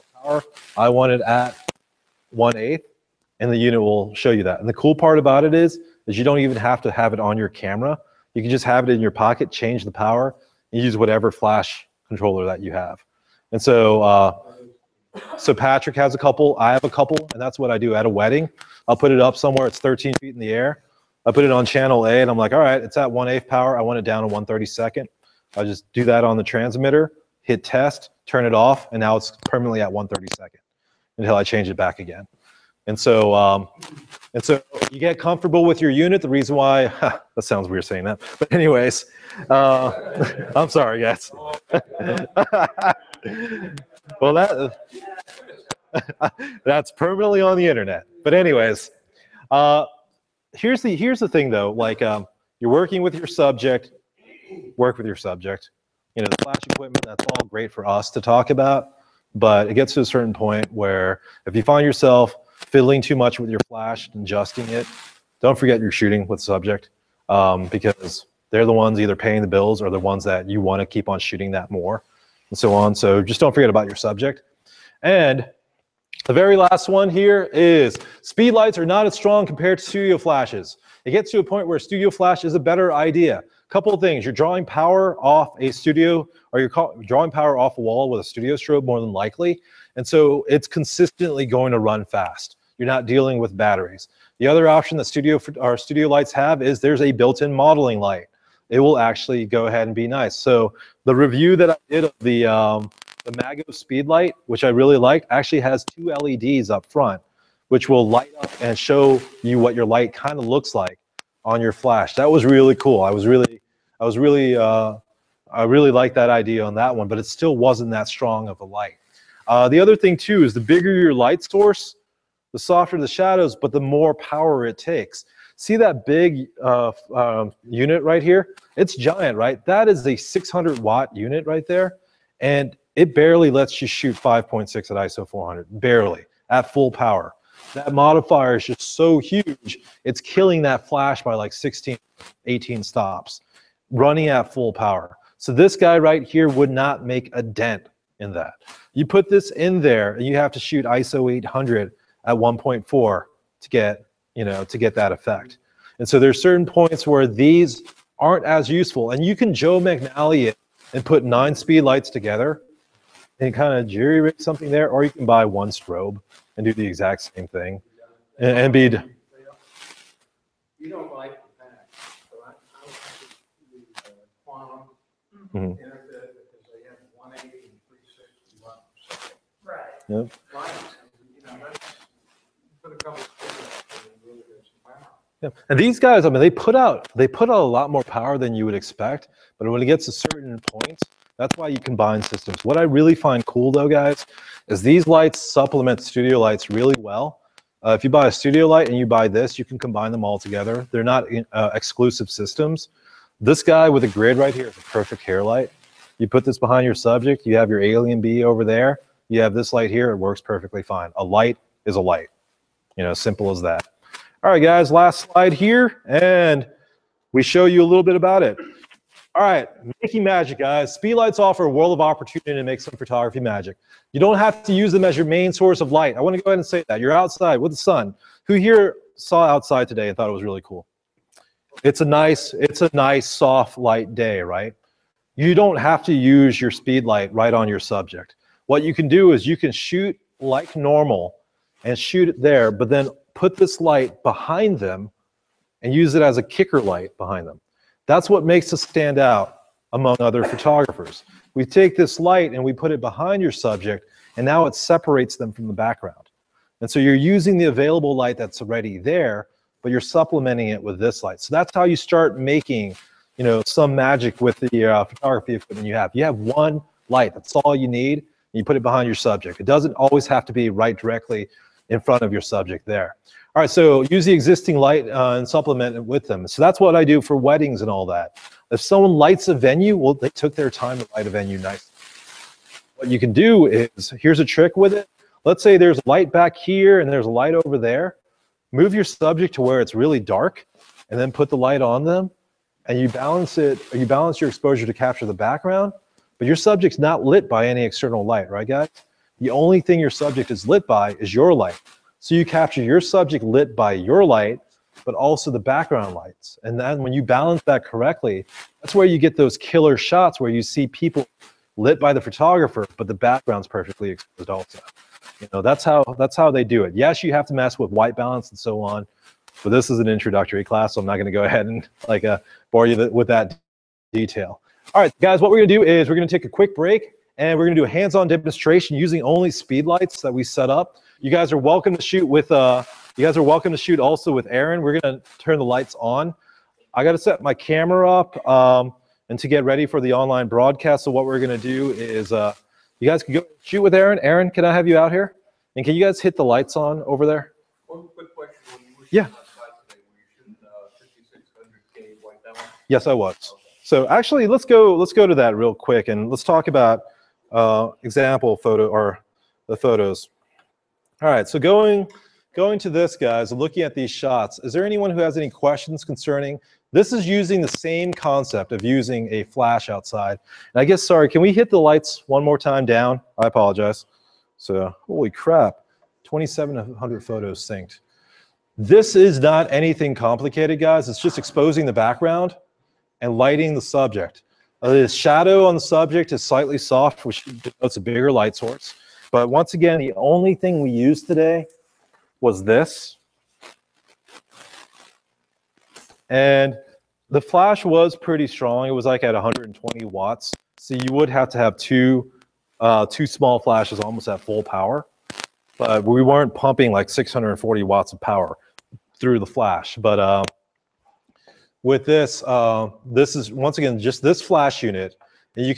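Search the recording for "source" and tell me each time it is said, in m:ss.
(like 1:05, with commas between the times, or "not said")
2:01, 3:45, 6:28.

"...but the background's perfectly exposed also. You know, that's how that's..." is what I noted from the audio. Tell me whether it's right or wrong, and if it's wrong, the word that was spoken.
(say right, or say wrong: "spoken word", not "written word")
right.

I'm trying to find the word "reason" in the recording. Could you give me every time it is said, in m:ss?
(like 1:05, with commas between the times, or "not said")
0:36.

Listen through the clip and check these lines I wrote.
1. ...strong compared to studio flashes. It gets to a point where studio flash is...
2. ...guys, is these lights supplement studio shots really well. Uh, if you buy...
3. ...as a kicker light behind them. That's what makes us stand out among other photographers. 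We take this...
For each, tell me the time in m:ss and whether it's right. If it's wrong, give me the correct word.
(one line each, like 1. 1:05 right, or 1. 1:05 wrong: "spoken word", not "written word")
1. 1:19 right
2. 3:13 wrong: "lights", not "shots"
3. 4:06 right.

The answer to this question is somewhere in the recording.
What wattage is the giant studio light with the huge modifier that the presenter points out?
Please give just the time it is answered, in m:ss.
2:10.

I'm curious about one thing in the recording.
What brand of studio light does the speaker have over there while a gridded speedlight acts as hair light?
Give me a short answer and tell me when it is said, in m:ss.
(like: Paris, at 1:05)
AlienBee, at 3:27.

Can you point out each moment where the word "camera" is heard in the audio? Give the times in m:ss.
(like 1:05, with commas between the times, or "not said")
0:07, 5:37.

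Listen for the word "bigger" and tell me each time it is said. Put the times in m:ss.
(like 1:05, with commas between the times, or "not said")
2:00, 6:27.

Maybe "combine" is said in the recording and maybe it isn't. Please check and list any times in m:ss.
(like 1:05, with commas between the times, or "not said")
3:11, 3:19.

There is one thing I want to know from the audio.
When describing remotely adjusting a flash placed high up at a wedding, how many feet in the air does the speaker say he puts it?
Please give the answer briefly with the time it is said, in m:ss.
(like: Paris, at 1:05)
13, at 0:19.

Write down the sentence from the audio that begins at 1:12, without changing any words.
So just don't forget about your subject.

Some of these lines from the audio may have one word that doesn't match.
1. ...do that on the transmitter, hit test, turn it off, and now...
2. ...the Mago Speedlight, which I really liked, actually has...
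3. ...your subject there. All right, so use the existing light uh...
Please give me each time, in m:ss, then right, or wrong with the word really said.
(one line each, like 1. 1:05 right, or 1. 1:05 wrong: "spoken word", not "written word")
1. 0:25 right
2. 1:43 right
3. 4:32 right.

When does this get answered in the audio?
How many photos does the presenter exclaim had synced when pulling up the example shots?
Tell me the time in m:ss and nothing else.
6:16.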